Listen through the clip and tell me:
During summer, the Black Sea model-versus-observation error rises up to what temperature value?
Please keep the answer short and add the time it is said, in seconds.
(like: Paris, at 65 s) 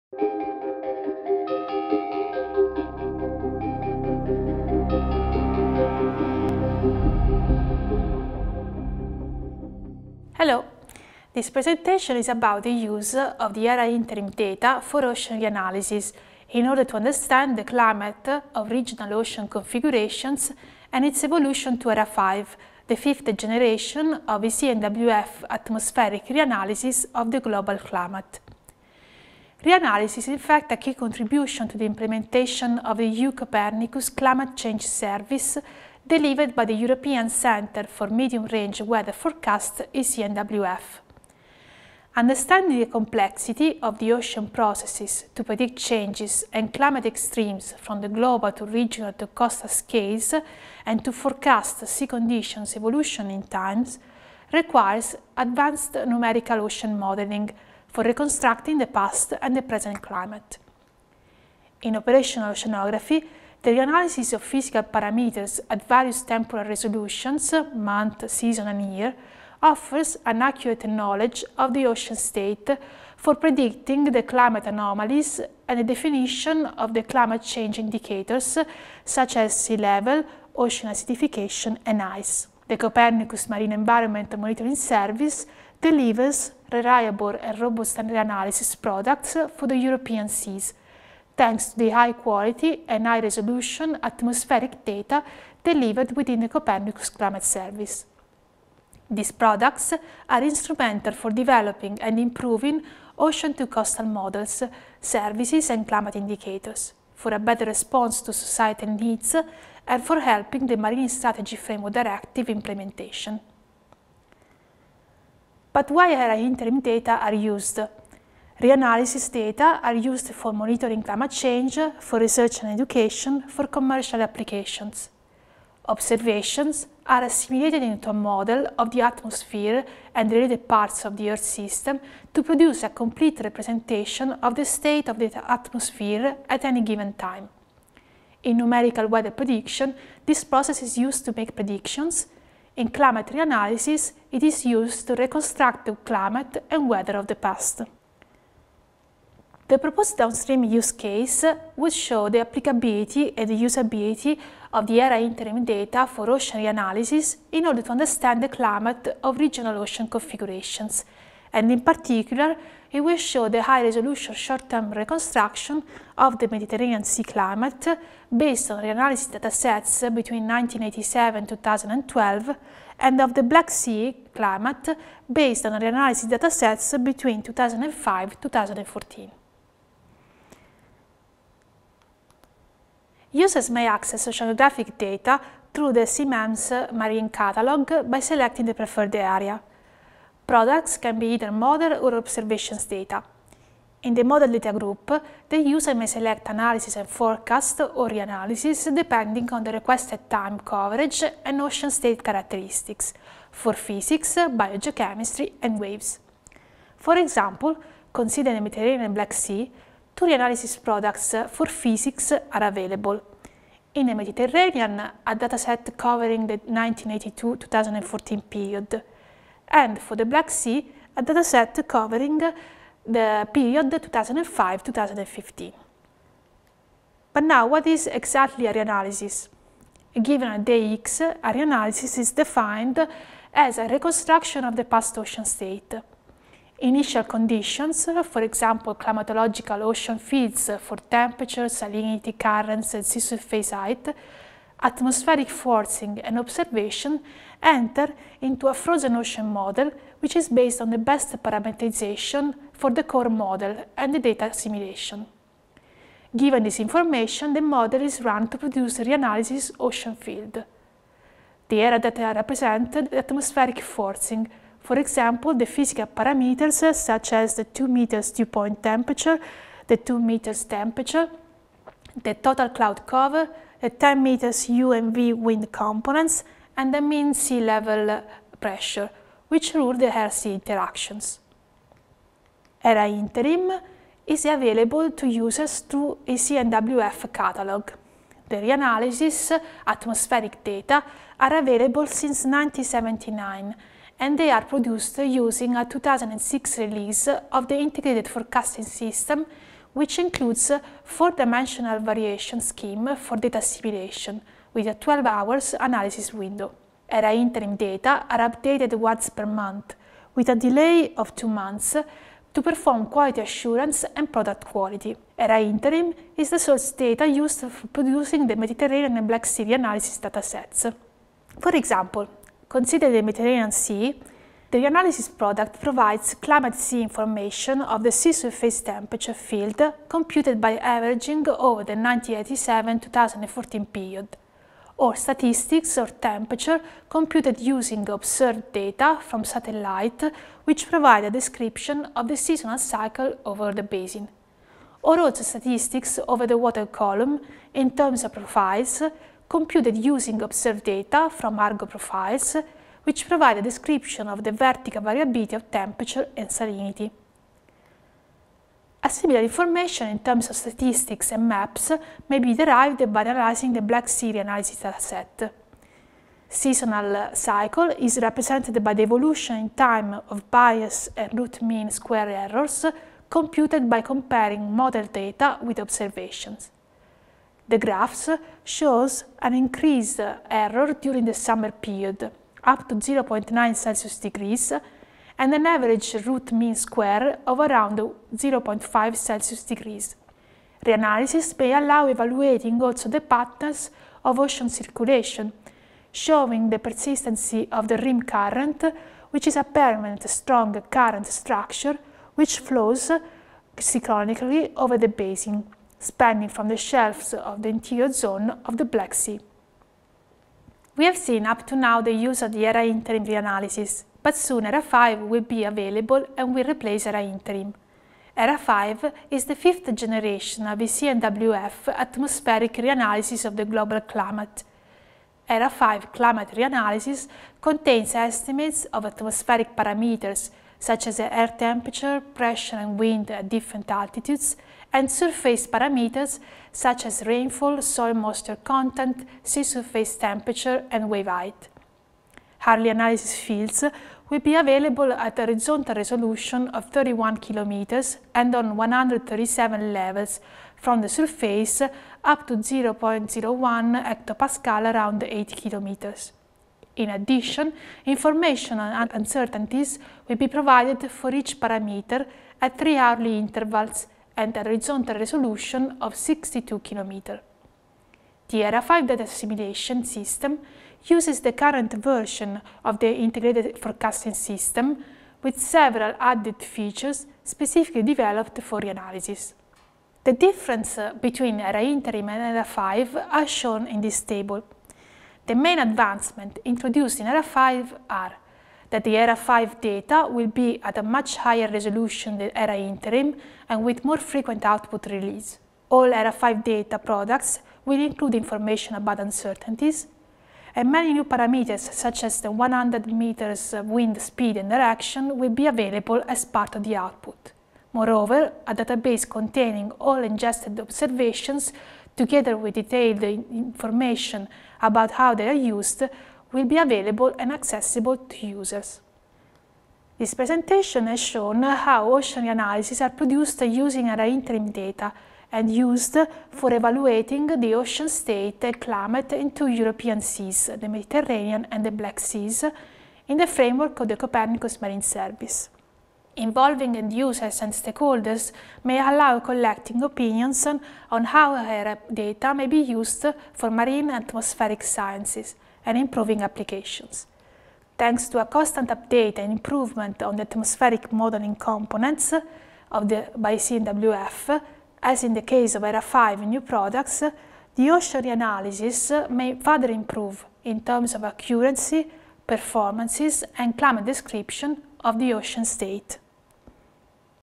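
0.9 Celsius degrees, at 382 s.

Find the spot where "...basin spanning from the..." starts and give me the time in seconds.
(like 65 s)
405 s.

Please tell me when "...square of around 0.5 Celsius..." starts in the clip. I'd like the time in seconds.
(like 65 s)
386 s.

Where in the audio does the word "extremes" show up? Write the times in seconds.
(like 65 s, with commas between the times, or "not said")
47 s.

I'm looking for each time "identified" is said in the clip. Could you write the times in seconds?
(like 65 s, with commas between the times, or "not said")
not said.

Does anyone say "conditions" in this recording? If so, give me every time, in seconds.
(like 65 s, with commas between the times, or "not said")
52 s, 237 s.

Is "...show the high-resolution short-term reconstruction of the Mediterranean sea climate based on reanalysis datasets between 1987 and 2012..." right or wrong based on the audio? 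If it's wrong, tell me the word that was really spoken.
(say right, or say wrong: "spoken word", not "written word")
right.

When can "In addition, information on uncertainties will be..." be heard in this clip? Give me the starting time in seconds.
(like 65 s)
456 s.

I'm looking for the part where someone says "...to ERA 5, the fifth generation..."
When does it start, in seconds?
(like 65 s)
21 s.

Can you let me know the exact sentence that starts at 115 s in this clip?
But why ERA interim data are used Reanalysis data are used for monitoring climate change, for research and education, for commercial applications.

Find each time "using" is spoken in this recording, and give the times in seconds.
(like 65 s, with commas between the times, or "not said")
295 s, 337 s, 350 s, 523 s.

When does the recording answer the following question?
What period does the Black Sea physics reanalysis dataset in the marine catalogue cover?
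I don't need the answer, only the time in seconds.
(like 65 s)
223 s.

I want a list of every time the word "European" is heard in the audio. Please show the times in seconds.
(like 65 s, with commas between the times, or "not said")
36 s, 89 s, 529 s.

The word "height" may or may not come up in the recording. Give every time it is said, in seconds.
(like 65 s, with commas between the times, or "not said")
243 s, 441 s.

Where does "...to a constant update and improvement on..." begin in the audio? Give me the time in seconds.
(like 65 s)
548 s.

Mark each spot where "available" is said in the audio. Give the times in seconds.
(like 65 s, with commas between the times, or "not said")
212 s, 284 s, 291 s, 415 s, 444 s, 505 s, 516 s.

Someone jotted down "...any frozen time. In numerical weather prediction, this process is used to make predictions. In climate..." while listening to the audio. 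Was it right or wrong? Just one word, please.
wrong.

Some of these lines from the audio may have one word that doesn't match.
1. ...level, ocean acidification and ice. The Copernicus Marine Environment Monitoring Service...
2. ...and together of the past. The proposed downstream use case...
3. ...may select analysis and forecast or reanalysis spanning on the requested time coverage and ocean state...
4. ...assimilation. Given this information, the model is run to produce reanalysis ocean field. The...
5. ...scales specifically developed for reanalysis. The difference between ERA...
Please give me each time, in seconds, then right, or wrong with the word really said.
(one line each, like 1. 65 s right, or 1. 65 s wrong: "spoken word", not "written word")
1. 79 s right
2. 146 s wrong: "weather", not "together"
3. 195 s wrong: "depending", not "spanning"
4. 254 s right
5. 476 s wrong: "features", not "scales".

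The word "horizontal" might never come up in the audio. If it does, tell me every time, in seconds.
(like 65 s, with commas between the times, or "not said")
445 s, 464 s.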